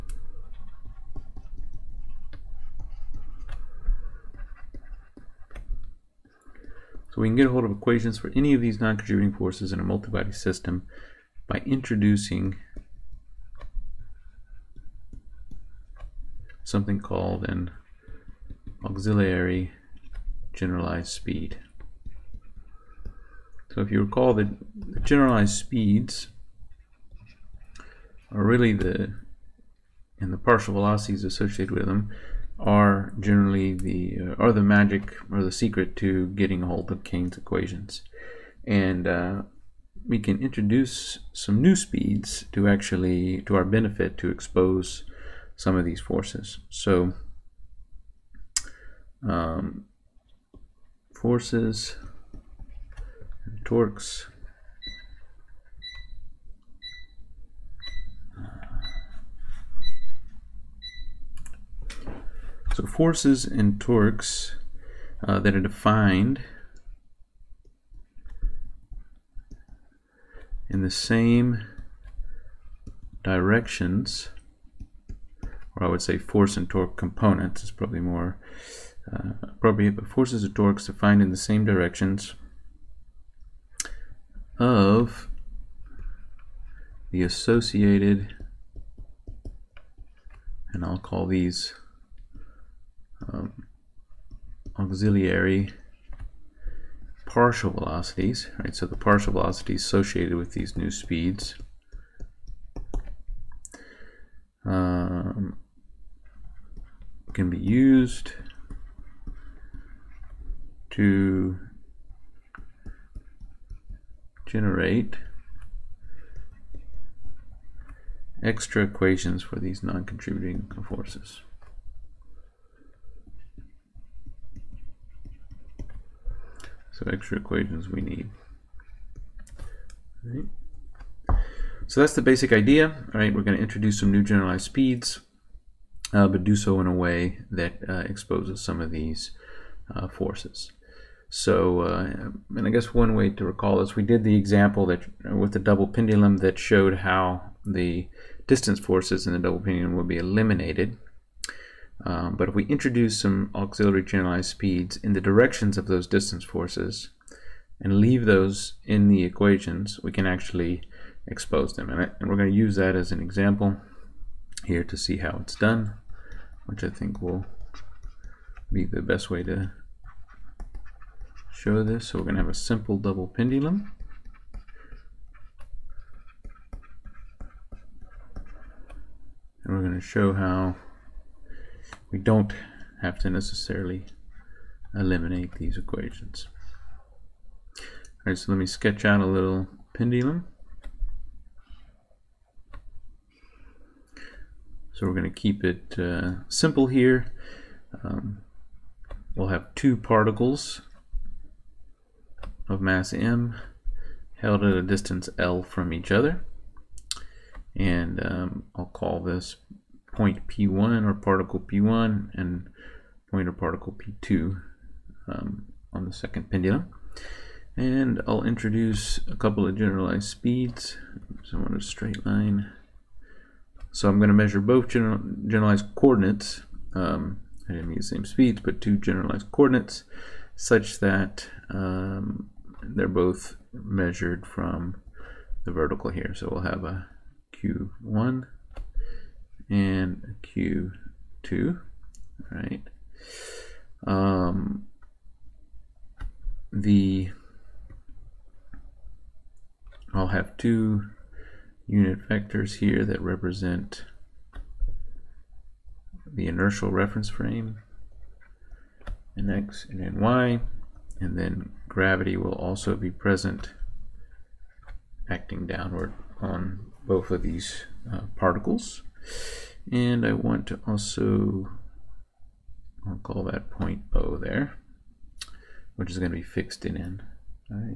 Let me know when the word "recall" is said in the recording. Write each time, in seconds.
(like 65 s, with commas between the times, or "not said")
24 s, 143 s.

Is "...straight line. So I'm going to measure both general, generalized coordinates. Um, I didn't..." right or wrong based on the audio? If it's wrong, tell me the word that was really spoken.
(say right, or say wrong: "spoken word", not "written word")
right.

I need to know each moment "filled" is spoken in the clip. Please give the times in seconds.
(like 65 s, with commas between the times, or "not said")
not said.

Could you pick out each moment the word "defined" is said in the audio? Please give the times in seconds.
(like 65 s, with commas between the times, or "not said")
65 s, 80 s.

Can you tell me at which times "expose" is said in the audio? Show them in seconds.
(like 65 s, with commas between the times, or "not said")
44 s, 138 s, 161 s.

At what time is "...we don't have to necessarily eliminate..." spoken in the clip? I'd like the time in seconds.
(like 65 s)
182 s.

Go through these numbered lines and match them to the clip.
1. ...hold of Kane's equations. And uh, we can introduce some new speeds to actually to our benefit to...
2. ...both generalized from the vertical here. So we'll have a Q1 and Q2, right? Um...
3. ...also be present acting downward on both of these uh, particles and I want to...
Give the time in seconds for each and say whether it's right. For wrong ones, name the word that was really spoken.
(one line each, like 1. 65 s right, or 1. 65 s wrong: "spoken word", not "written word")
1. 36 s right
2. 233 s wrong: "measured", not "generalized"
3. 262 s right.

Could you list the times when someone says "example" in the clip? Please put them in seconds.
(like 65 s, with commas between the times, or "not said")
144 s, 163 s.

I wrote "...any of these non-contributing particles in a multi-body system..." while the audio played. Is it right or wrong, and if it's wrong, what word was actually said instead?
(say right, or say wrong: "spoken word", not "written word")
wrong: "forces", not "particles".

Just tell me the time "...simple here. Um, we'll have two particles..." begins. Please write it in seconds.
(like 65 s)
196 s.